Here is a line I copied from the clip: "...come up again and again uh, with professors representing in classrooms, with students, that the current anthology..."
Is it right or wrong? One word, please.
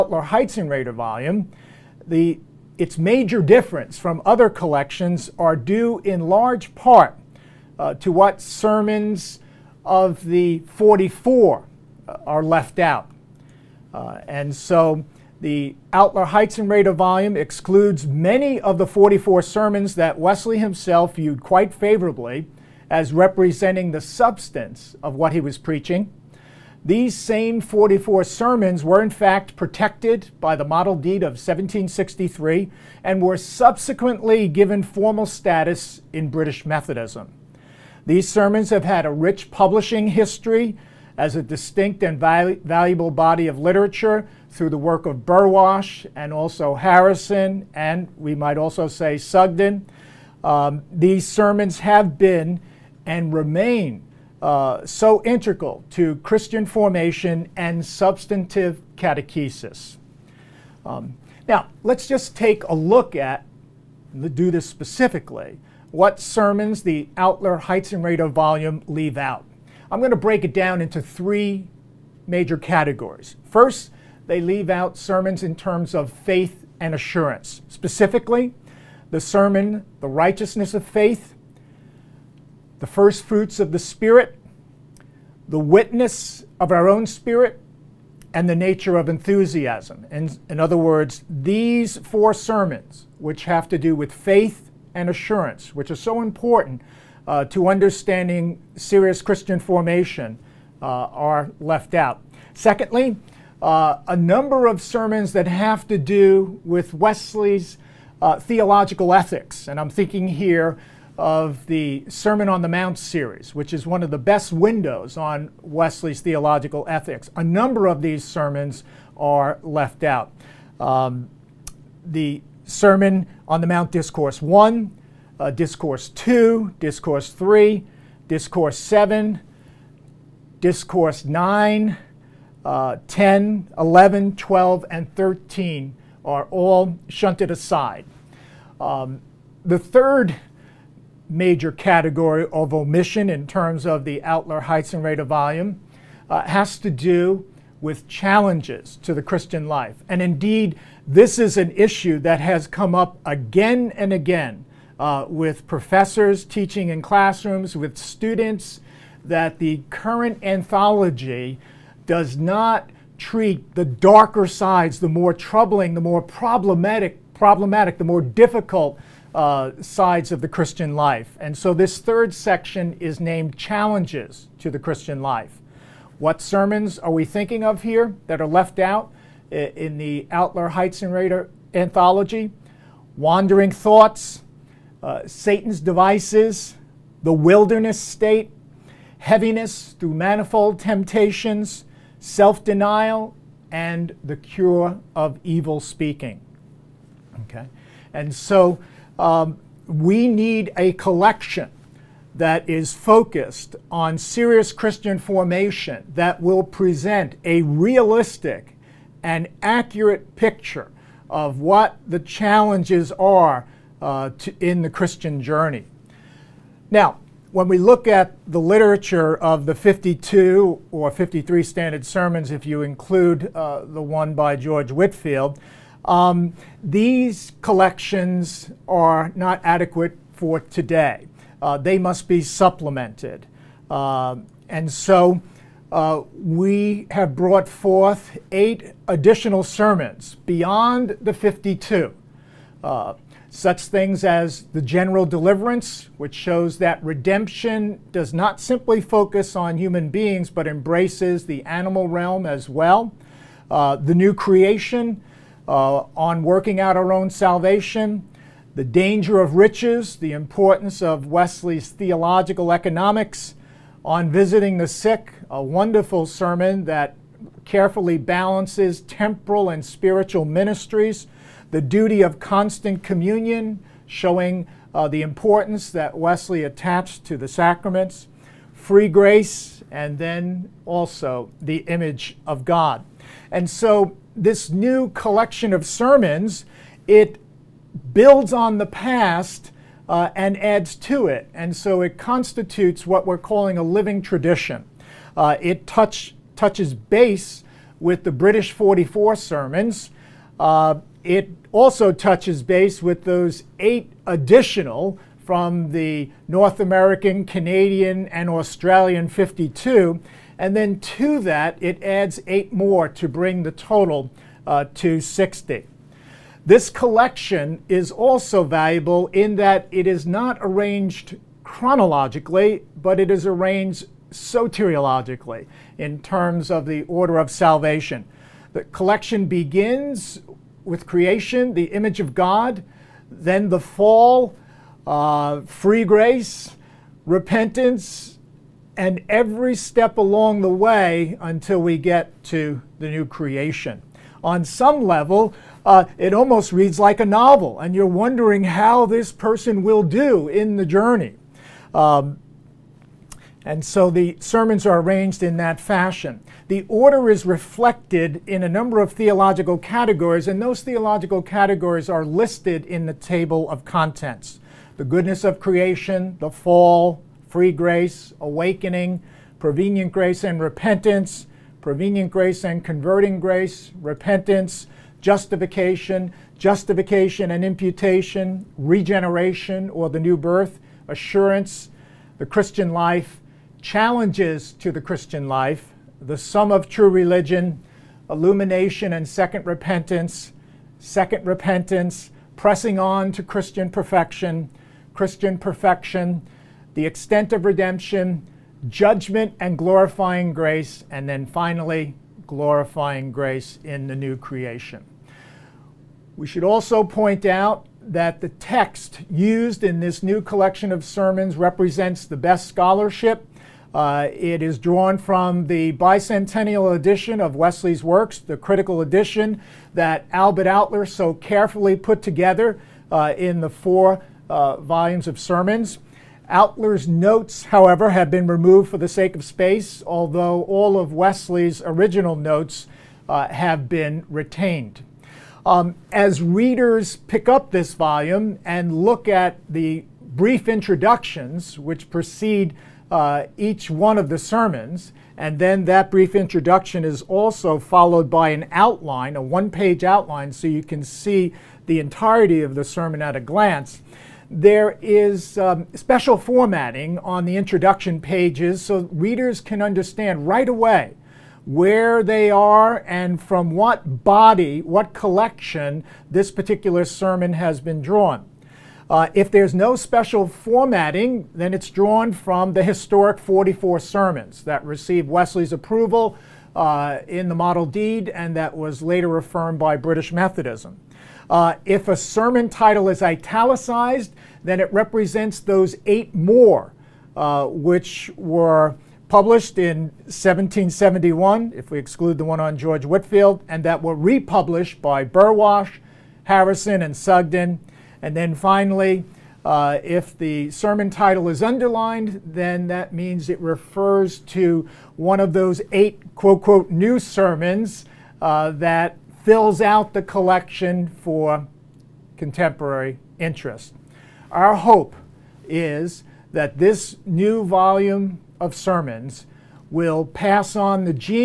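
wrong.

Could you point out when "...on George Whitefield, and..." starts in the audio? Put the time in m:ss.
8:12.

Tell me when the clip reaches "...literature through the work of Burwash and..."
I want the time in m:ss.
0:43.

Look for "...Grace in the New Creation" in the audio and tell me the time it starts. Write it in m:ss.
6:43.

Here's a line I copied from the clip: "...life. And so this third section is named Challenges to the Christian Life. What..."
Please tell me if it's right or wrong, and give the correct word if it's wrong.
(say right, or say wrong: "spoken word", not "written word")
right.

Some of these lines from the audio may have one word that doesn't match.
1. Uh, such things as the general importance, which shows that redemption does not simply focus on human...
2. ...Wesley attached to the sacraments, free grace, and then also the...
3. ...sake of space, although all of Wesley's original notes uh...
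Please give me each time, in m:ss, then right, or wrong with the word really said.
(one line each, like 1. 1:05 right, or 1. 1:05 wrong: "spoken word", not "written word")
1. 4:02 wrong: "deliverance", not "importance"
2. 4:36 right
3. 7:09 right.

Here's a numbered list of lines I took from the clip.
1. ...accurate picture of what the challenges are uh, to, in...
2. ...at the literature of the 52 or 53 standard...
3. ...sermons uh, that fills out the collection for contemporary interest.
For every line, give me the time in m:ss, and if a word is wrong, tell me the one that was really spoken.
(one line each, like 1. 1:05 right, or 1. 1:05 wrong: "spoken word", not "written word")
1. 3:29 right
2. 3:38 right
3. 8:27 right.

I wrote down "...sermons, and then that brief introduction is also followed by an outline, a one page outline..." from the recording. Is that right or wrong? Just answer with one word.
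right.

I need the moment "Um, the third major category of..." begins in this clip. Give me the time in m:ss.
2:18.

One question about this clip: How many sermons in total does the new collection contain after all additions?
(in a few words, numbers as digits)
60.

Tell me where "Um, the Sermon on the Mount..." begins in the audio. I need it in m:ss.
2:00.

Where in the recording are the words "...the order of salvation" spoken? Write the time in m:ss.
5:26.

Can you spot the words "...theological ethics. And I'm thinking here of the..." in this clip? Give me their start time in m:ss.
1:48.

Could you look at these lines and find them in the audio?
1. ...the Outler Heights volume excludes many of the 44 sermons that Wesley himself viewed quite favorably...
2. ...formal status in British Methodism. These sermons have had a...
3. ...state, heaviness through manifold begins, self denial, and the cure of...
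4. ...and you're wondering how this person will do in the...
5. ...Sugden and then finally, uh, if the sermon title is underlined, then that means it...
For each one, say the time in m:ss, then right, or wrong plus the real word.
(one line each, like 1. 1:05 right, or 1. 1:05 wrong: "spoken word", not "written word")
1. 0:15 right
2. 0:34 right
3. 3:07 wrong: "temptations", not "begins"
4. 5:47 right
5. 8:17 right.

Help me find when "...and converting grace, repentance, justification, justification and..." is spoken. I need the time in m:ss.
6:12.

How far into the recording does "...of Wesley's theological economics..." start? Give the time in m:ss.
4:21.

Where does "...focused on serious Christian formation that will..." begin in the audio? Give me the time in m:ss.
3:22.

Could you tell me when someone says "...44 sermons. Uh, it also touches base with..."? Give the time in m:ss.
4:58.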